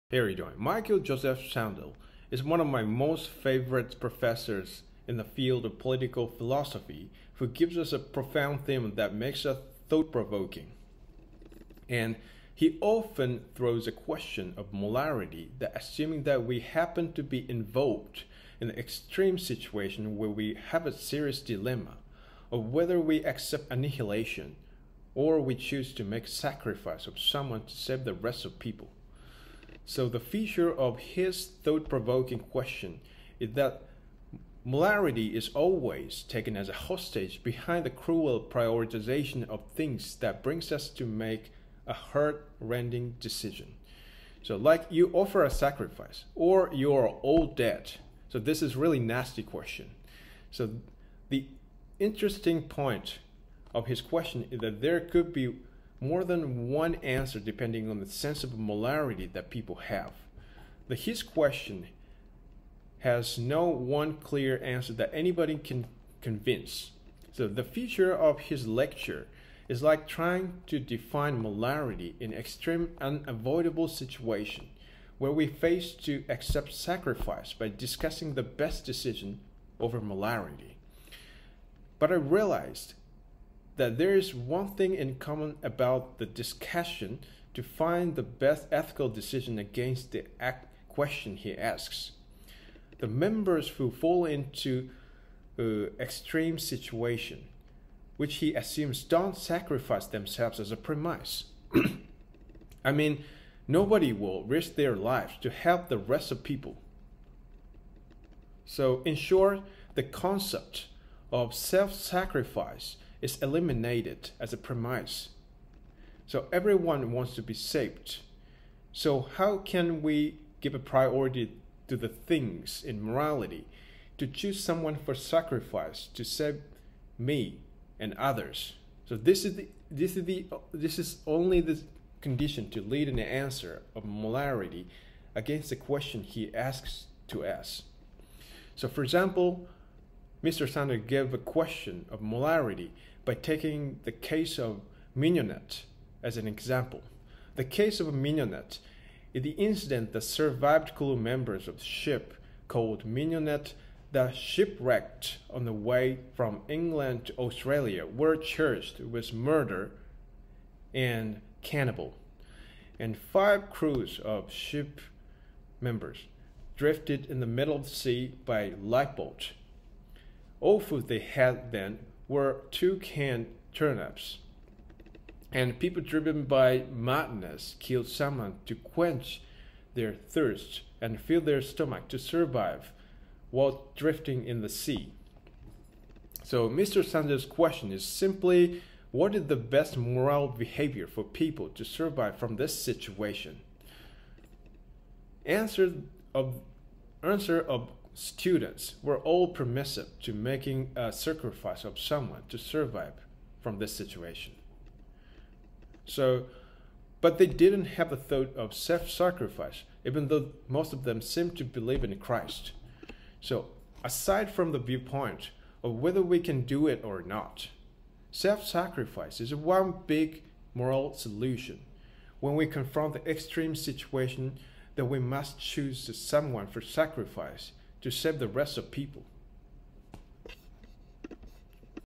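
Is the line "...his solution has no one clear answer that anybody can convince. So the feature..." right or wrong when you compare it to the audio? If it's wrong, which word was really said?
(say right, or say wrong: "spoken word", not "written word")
wrong: "question", not "solution".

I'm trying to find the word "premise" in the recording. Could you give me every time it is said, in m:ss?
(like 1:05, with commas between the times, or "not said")
1:40, 1:54.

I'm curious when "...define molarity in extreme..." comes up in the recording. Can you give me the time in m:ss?
1:10.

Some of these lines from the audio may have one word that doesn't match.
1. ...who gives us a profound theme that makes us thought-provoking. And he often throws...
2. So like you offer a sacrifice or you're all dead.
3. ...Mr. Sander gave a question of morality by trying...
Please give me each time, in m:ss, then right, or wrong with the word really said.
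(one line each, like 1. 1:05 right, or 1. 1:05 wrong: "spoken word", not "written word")
1. 0:07 right
2. 0:44 right
3. 2:20 wrong: "taking", not "trying".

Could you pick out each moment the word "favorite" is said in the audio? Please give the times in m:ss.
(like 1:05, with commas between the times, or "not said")
0:03.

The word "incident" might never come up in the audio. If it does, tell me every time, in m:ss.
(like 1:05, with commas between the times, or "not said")
2:29.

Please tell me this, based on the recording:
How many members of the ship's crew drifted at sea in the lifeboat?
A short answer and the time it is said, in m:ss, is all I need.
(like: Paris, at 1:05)
5, at 2:43.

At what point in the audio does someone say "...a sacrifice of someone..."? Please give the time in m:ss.
3:20.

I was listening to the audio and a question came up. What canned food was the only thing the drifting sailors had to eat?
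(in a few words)
two canned turnips.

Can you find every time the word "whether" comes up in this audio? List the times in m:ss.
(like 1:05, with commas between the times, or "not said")
0:22, 3:35.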